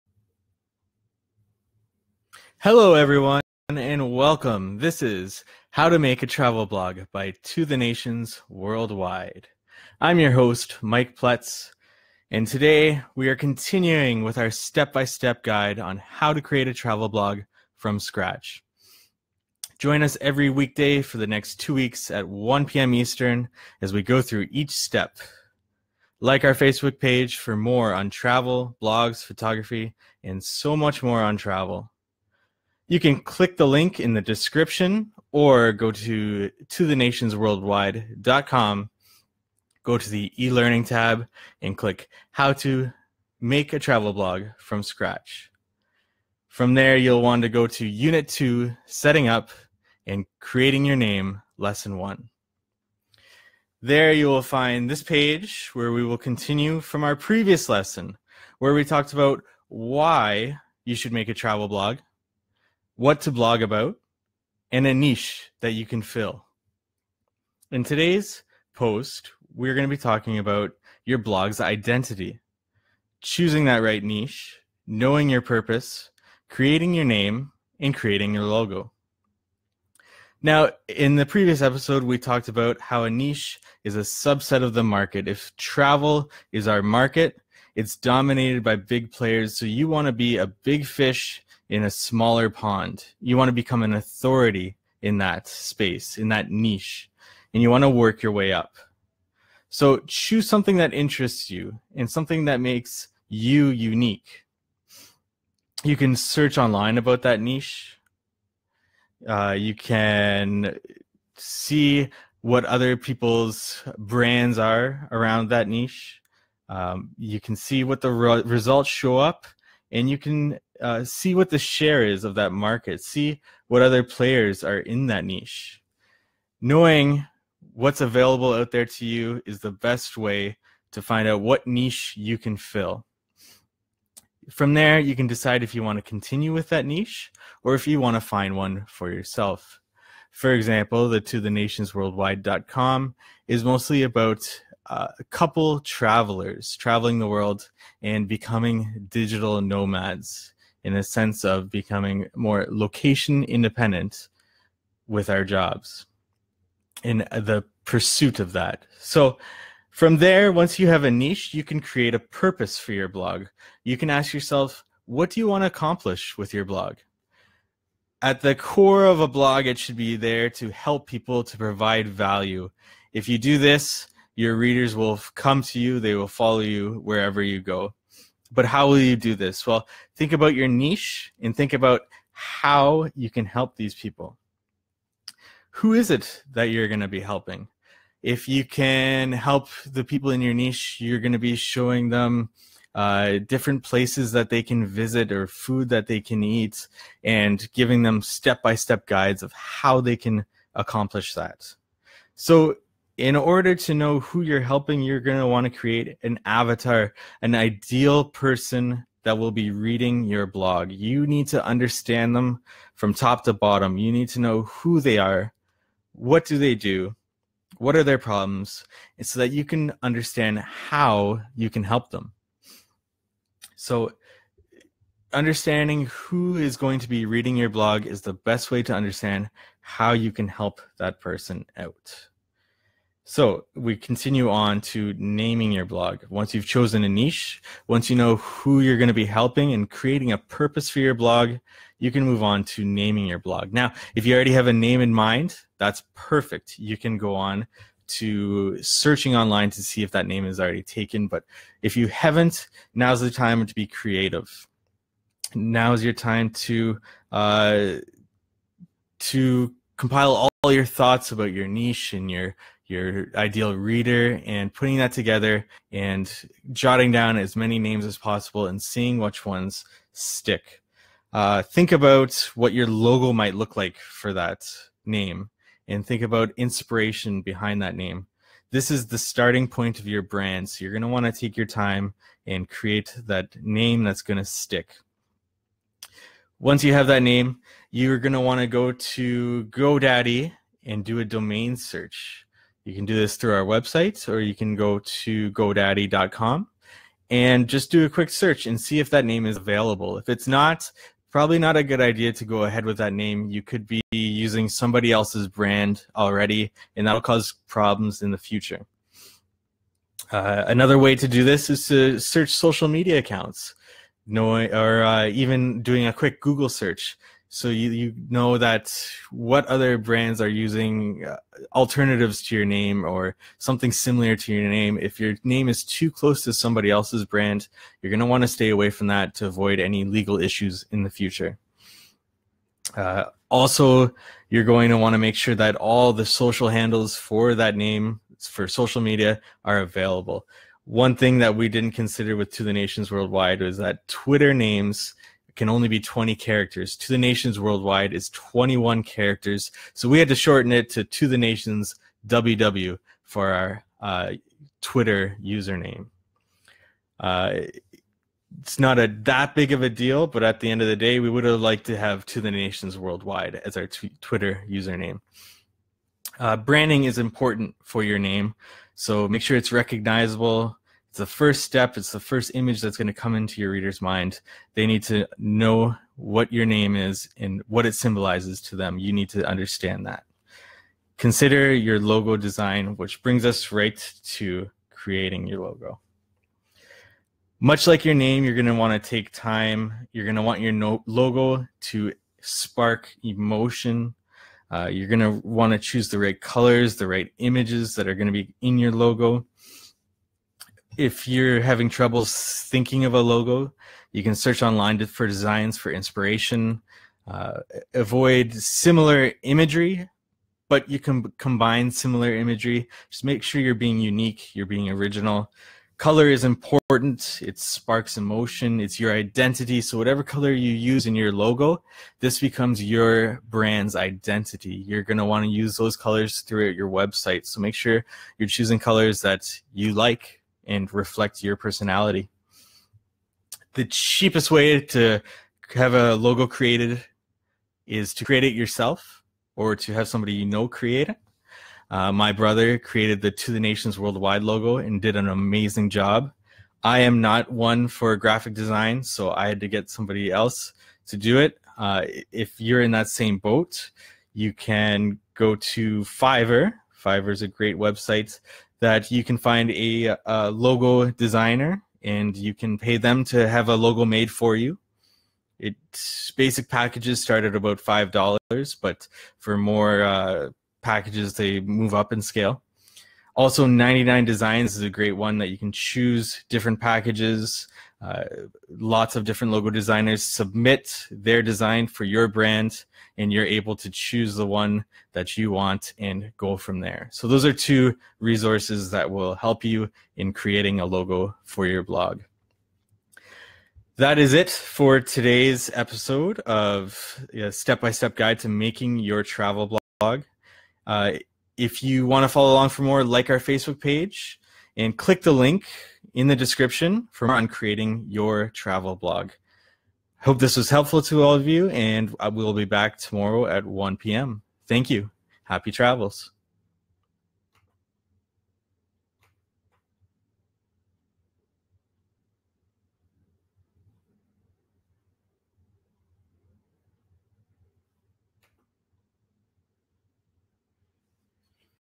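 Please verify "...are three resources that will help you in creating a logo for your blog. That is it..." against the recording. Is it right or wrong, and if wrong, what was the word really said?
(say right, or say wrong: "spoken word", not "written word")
wrong: "two", not "three".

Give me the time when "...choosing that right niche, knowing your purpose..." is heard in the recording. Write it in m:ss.
1:13.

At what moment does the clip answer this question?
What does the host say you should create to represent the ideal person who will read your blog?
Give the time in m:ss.
3:26.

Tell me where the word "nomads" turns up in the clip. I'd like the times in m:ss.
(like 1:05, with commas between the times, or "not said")
2:29.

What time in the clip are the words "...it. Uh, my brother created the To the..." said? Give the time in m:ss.
7:21.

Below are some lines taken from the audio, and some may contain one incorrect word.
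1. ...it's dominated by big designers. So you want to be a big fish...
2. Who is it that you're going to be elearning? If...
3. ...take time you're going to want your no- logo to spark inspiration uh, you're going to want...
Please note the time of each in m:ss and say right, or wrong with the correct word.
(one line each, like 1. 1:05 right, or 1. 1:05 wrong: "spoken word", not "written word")
1. 1:27 wrong: "players", not "designers"
2. 3:05 wrong: "helping", not "elearning"
3. 6:29 wrong: "emotion", not "inspiration".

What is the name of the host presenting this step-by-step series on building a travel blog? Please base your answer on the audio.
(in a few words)
Mike Pletz.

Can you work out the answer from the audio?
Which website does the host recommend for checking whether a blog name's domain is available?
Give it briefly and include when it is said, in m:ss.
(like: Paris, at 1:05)
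GoDaddy, at 4:55.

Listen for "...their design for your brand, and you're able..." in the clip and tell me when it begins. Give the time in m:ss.
8:01.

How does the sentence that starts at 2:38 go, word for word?
So from there, once you have a niche, you can create a purpose for your blog.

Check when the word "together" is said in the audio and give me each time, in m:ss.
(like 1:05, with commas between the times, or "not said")
4:25.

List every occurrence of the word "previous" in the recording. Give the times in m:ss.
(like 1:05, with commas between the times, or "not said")
0:57, 1:21.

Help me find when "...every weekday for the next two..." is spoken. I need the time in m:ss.
0:20.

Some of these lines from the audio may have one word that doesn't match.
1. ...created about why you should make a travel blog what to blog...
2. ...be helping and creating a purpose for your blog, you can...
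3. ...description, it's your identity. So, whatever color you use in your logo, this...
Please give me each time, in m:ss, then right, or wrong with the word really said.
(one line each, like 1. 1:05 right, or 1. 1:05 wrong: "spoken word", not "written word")
1. 0:58 wrong: "talked", not "created"
2. 3:59 right
3. 6:58 wrong: "emotion", not "description".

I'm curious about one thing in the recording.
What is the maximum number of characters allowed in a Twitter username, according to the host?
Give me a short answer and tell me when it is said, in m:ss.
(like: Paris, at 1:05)
20, at 5:45.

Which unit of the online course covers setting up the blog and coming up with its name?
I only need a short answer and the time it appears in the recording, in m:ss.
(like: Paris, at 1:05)
Unit 2, at 0:47.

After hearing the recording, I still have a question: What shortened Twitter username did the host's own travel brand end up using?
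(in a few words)
To the Nations WW.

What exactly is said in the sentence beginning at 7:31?
Uh, if you're in that same boat, you can go to Fiverr.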